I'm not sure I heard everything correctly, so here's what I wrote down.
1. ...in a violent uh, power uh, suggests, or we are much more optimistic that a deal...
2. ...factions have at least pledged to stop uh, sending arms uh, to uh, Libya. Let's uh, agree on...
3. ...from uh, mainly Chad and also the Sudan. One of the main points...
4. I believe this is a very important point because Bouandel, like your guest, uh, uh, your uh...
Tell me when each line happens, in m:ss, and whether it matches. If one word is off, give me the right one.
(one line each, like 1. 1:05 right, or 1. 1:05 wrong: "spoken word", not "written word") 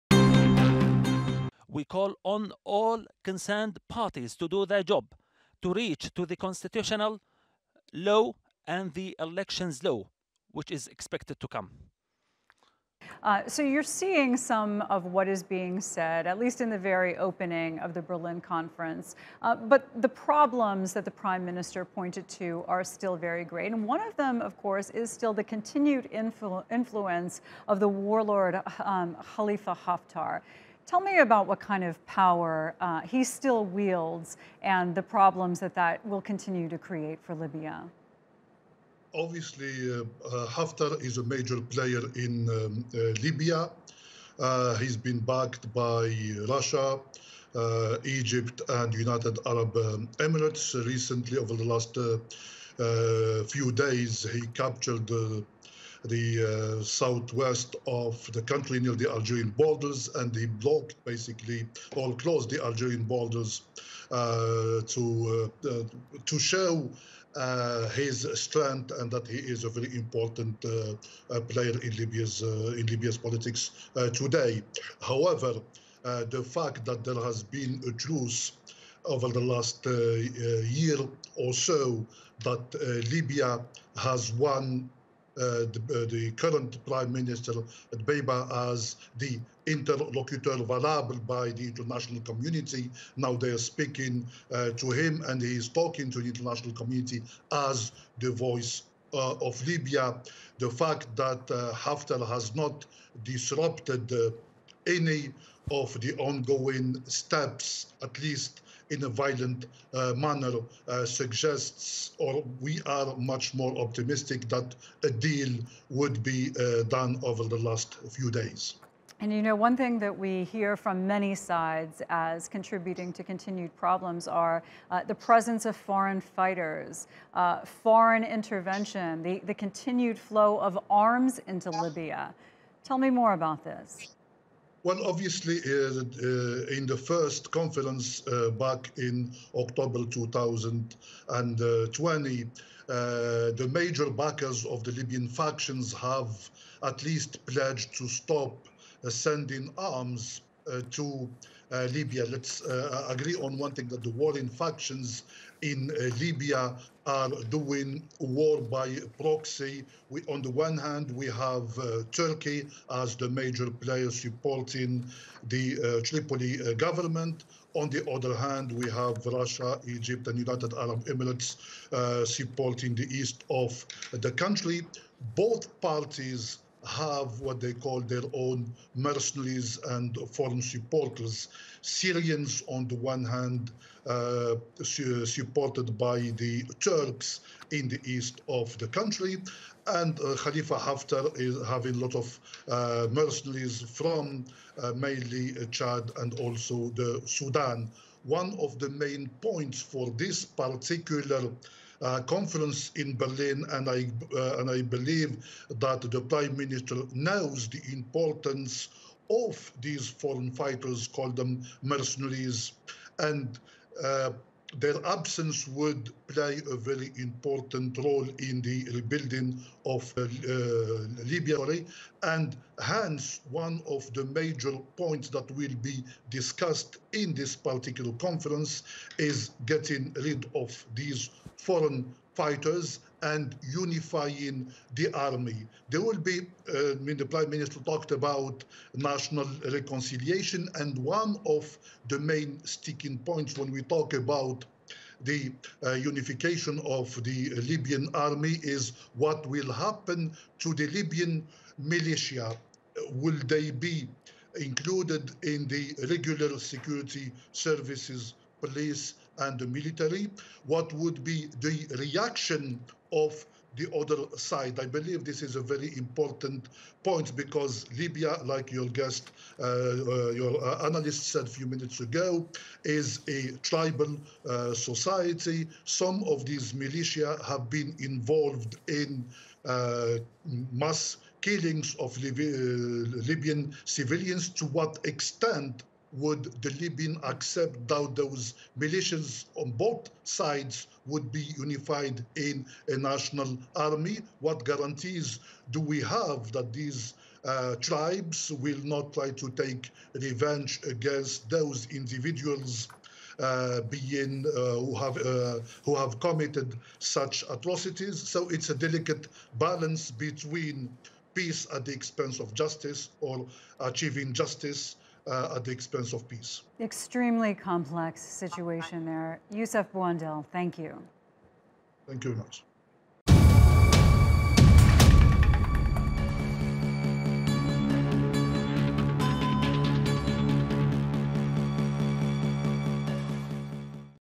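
1. 1:48 wrong: "manner", not "power"
2. 2:25 right
3. 3:13 right
4. 4:24 wrong: "Libya", not "Bouandel".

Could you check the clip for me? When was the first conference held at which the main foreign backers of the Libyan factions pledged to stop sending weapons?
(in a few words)
October 2020.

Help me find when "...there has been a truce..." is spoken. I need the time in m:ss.
1:17.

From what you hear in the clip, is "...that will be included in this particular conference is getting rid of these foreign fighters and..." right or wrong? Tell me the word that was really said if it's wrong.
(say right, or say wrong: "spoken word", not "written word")
wrong: "discussed", not "included".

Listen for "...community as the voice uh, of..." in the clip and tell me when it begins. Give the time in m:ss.
1:36.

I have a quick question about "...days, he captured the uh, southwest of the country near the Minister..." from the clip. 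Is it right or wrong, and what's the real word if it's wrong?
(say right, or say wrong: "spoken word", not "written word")
wrong: "Algerian", not "Minister".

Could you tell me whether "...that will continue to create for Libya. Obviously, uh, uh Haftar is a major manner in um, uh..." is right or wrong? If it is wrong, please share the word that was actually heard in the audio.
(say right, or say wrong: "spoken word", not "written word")
wrong: "player", not "manner".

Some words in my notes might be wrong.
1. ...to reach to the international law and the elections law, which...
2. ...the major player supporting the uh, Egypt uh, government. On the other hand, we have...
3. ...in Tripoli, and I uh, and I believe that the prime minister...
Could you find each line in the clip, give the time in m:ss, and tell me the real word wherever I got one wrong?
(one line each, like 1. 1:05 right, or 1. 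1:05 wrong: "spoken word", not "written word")
1. 0:05 wrong: "constitutional", not "international"
2. 2:43 wrong: "Tripoli", not "Egypt"
3. 3:22 wrong: "Berlin", not "Tripoli".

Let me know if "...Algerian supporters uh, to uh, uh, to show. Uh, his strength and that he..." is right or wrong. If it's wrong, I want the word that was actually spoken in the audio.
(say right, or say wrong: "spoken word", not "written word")
wrong: "borders", not "supporters".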